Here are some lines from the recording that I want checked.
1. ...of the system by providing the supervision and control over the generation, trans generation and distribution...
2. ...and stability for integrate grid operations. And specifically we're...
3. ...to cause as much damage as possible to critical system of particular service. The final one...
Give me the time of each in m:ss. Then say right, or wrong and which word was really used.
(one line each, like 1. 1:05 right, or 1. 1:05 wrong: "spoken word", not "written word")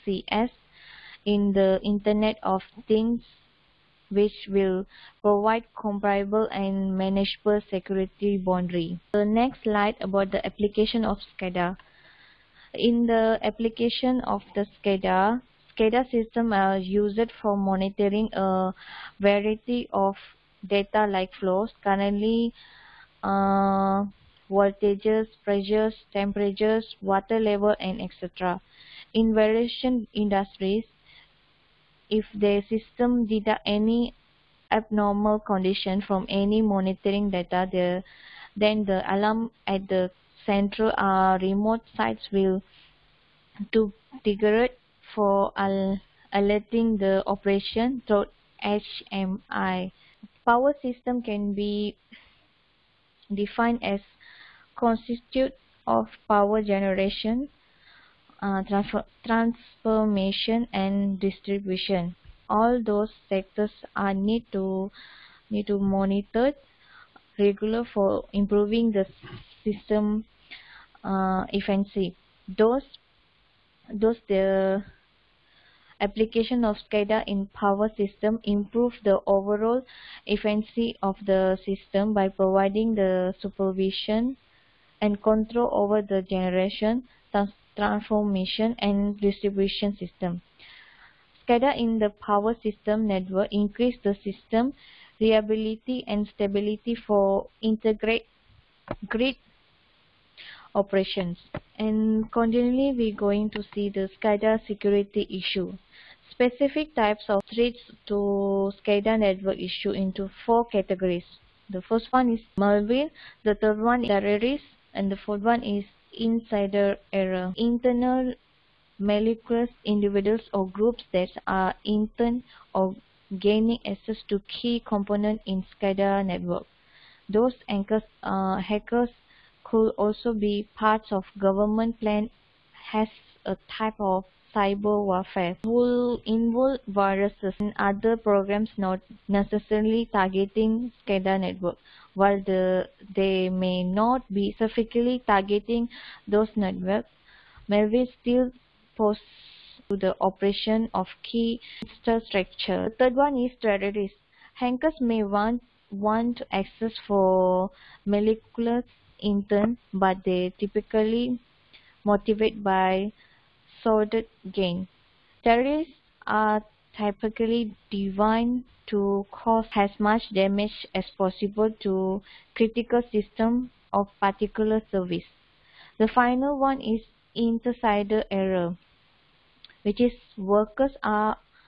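1. 1:21 wrong: "transformation", not "generation"
2. 1:36 wrong: "continually", not "specifically"
3. 2:48 right.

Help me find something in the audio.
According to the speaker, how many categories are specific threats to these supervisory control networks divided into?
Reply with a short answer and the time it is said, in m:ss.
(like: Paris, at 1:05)
4, at 1:50.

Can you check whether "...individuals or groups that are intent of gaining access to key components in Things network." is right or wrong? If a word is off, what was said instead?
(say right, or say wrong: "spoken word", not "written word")
wrong: "SCADA", not "Things".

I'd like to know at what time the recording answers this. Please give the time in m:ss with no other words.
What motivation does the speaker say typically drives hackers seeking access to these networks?
2:43.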